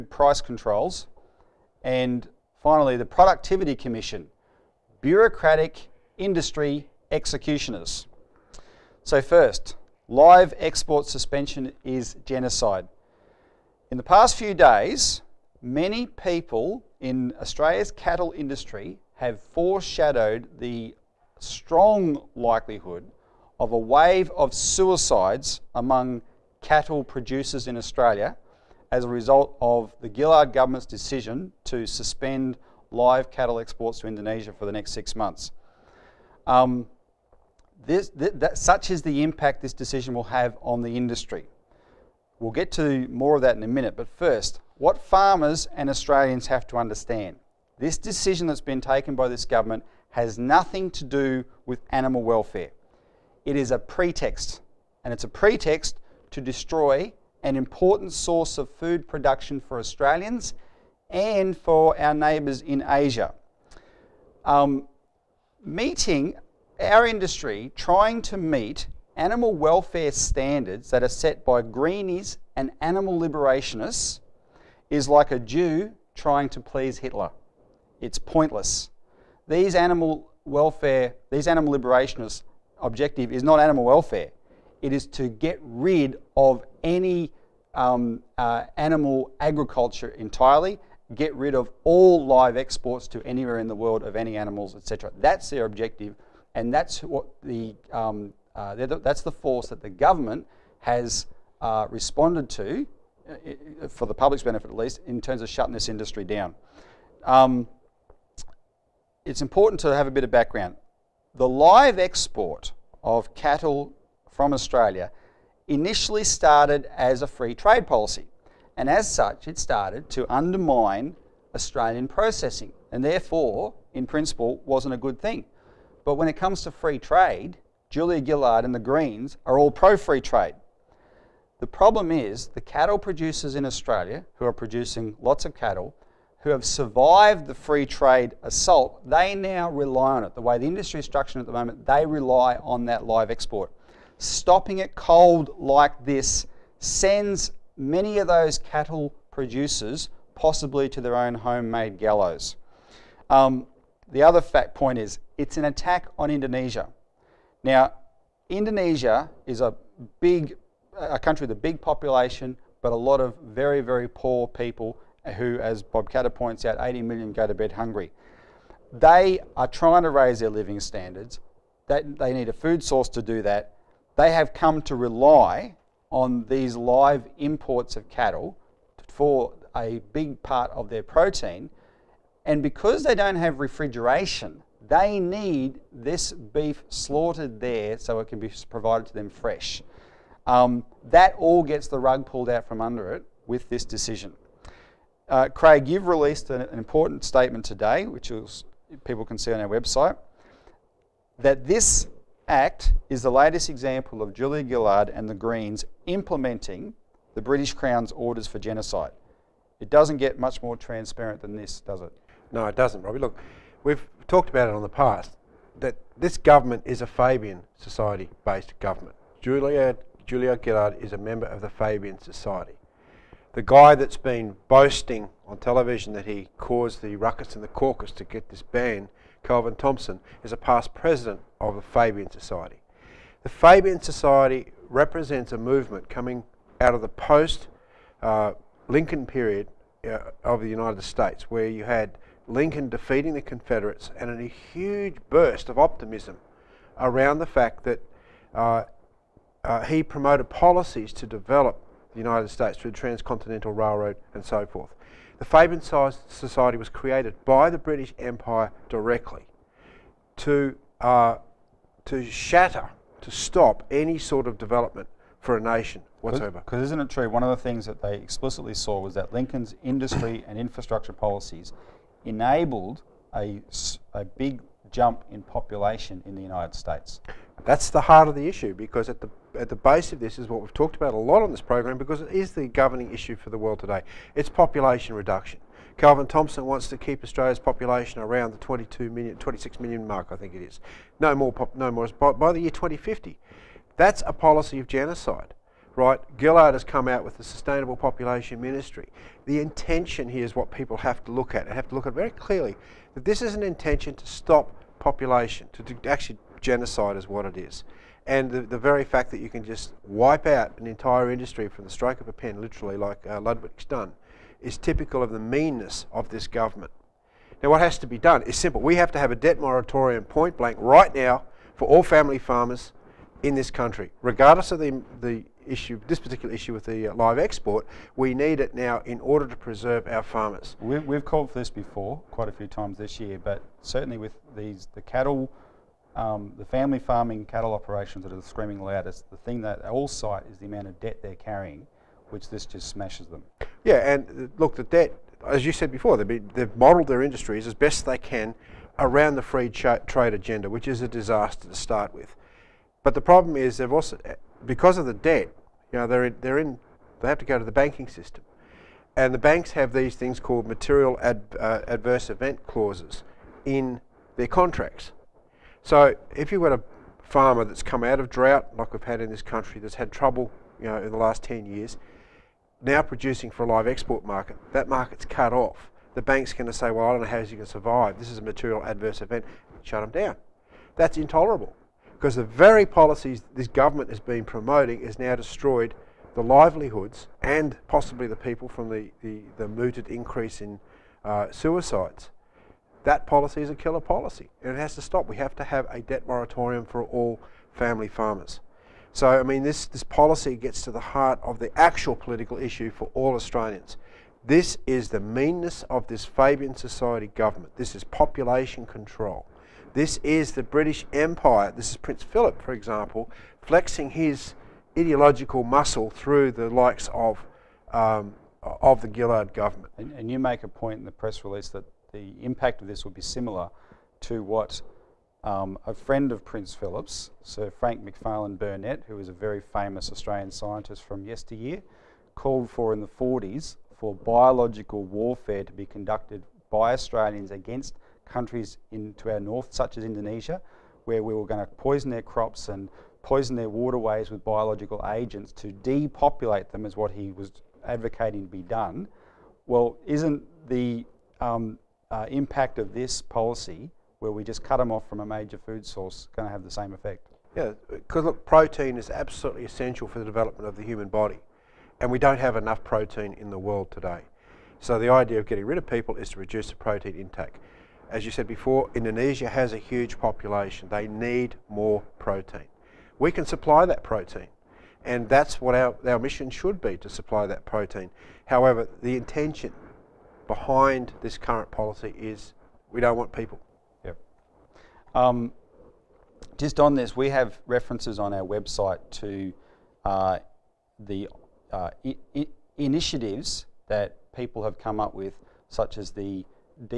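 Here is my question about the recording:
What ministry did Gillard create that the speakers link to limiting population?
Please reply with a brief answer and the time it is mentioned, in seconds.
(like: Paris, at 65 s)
Sustainable Population Ministry, at 297 s.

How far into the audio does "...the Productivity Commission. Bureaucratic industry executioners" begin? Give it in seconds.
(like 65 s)
2 s.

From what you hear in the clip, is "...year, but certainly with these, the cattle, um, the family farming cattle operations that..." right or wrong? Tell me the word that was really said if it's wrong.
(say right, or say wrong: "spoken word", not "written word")
right.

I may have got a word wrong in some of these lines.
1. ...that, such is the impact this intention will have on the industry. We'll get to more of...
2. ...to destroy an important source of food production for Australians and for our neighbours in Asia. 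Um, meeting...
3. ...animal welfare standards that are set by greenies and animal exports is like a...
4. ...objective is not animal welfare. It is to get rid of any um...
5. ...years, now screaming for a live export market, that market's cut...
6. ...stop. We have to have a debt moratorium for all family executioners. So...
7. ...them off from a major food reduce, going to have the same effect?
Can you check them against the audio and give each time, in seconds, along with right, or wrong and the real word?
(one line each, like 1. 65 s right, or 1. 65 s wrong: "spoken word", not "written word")
1. 38 s wrong: "decision", not "intention"
2. 56 s right
3. 69 s wrong: "liberationists", not "exports"
4. 82 s right
5. 371 s wrong: "producing", not "screaming"
6. 395 s wrong: "farmers", not "executioners"
7. 454 s wrong: "source", not "reduce".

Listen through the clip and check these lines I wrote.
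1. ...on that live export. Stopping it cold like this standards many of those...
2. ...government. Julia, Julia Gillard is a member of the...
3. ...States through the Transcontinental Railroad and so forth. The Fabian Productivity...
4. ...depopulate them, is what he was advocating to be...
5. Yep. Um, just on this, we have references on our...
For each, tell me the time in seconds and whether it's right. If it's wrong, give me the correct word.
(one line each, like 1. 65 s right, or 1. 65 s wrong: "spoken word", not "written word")
1. 142 s wrong: "sends", not "standards"
2. 218 s right
3. 252 s wrong: "Society", not "Productivity"
4. 445 s right
5. 484 s right.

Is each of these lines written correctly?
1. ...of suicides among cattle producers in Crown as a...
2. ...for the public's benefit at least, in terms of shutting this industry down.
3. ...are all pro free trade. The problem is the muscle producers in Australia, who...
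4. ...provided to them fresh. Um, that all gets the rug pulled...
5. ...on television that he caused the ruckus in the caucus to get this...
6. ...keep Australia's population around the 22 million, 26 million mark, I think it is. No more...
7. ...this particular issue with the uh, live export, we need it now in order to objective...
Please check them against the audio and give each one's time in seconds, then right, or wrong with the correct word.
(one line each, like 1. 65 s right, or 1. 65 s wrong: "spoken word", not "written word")
1. 24 s wrong: "Australia", not "Crown"
2. 103 s right
3. 129 s wrong: "cattle", not "muscle"
4. 188 s right
5. 225 s right
6. 286 s right
7. 326 s wrong: "preserve", not "objective".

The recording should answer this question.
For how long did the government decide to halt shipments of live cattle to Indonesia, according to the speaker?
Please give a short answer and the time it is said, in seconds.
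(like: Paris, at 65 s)
6 months, at 34 s.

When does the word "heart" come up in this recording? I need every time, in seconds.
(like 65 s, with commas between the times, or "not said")
278 s, 401 s.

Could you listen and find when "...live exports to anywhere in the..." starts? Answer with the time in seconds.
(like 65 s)
92 s.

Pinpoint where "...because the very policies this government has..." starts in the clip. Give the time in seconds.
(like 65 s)
382 s.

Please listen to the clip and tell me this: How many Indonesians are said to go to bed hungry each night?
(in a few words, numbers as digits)
80 million.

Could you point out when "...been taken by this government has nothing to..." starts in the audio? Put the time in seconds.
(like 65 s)
48 s.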